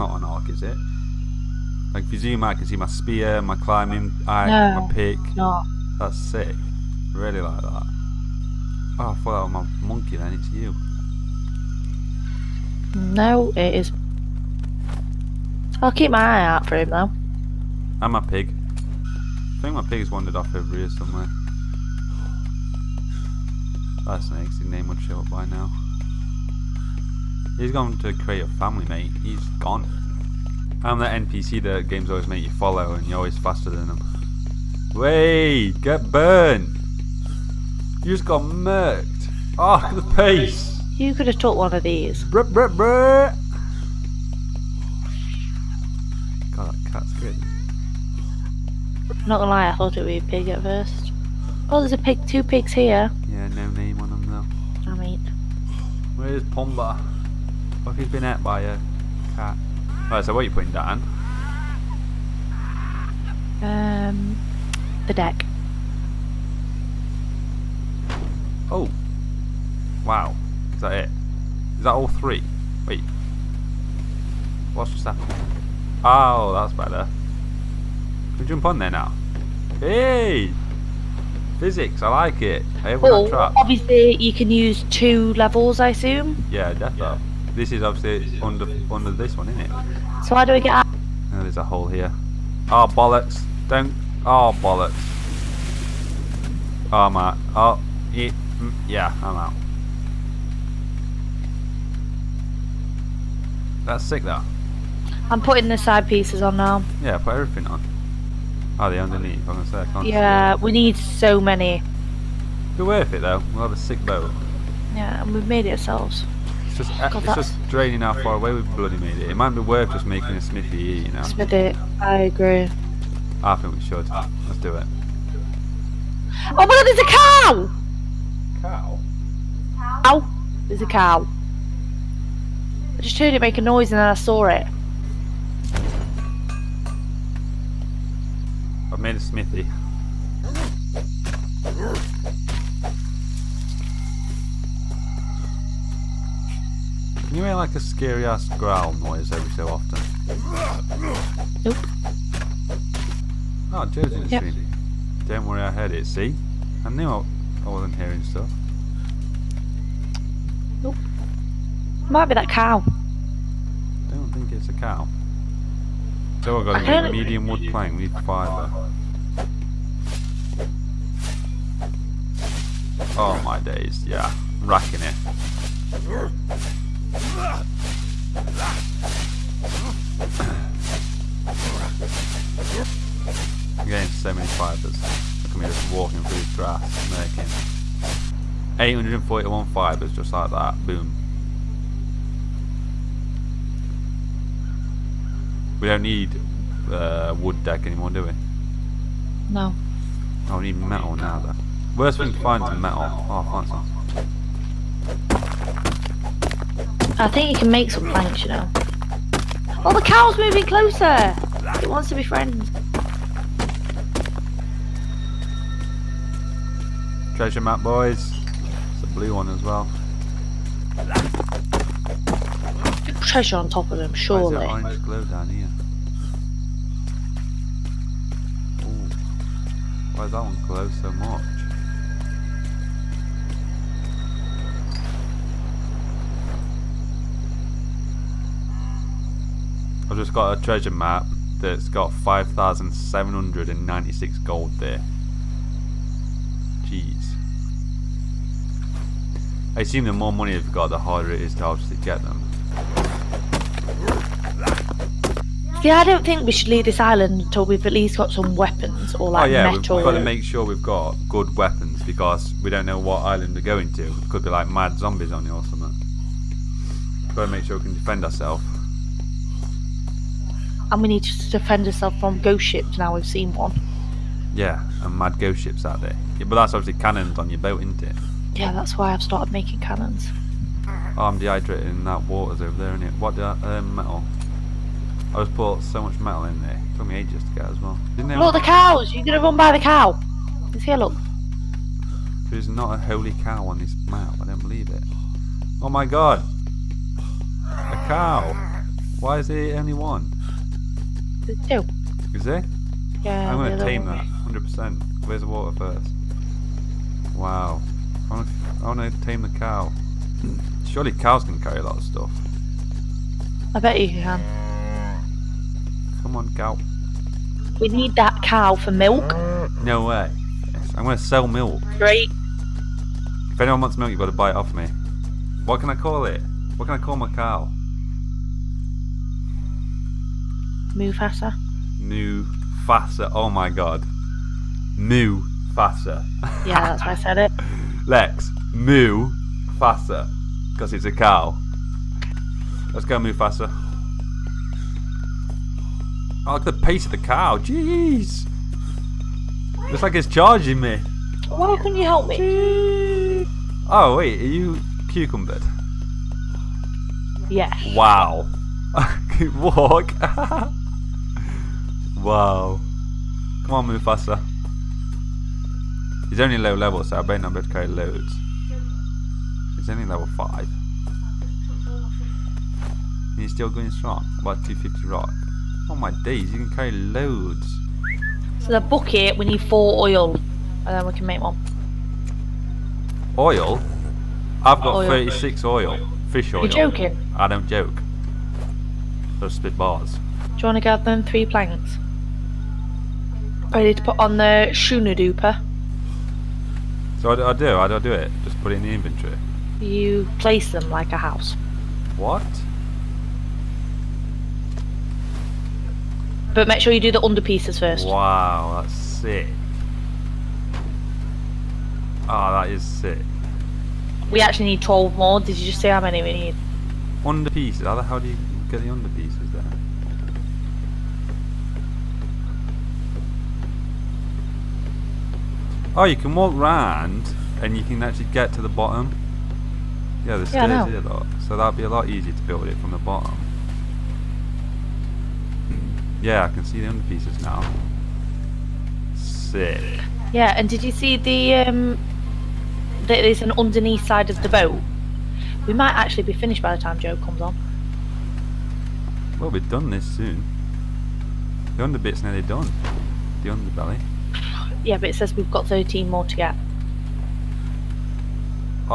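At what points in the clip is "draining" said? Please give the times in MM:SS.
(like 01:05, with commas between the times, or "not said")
01:57.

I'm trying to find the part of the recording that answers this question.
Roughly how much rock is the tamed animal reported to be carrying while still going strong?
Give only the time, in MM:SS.
06:14.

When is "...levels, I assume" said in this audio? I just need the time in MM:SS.
01:25.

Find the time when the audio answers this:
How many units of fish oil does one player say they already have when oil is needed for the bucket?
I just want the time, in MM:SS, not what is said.
06:25.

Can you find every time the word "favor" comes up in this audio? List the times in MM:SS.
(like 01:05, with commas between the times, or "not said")
not said.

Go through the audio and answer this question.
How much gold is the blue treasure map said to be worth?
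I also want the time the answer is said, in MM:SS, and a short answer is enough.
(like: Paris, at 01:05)
5,796, at 04:02.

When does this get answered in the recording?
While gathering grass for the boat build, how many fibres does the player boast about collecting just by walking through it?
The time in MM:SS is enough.
03:08.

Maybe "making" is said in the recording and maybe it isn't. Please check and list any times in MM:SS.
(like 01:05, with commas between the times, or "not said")
02:00, 03:07, 04:39.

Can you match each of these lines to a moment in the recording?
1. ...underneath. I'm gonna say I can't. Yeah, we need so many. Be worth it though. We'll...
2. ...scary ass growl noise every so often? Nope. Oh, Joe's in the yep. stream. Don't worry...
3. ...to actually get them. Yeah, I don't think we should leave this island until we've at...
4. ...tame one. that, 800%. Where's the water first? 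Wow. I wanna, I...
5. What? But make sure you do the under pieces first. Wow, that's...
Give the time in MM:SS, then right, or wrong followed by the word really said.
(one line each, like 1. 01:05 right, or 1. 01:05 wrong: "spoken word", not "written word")
1. 01:48 right
2. 02:27 right
3. 04:11 right
4. 05:03 wrong: "100", not "800"
5. 06:42 right.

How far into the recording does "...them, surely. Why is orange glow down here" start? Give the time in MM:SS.
03:43.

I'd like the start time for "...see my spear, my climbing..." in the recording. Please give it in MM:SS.
00:02.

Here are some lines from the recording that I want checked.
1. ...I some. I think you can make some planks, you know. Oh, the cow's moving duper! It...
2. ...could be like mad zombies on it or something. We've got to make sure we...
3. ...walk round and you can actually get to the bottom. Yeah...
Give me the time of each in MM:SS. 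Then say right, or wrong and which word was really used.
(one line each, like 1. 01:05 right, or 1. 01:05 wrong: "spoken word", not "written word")
1. 03:23 wrong: "closer", not "duper"
2. 04:24 right
3. 07:06 right.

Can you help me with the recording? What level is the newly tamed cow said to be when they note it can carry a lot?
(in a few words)
5.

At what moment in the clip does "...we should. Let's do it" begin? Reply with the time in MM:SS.
02:03.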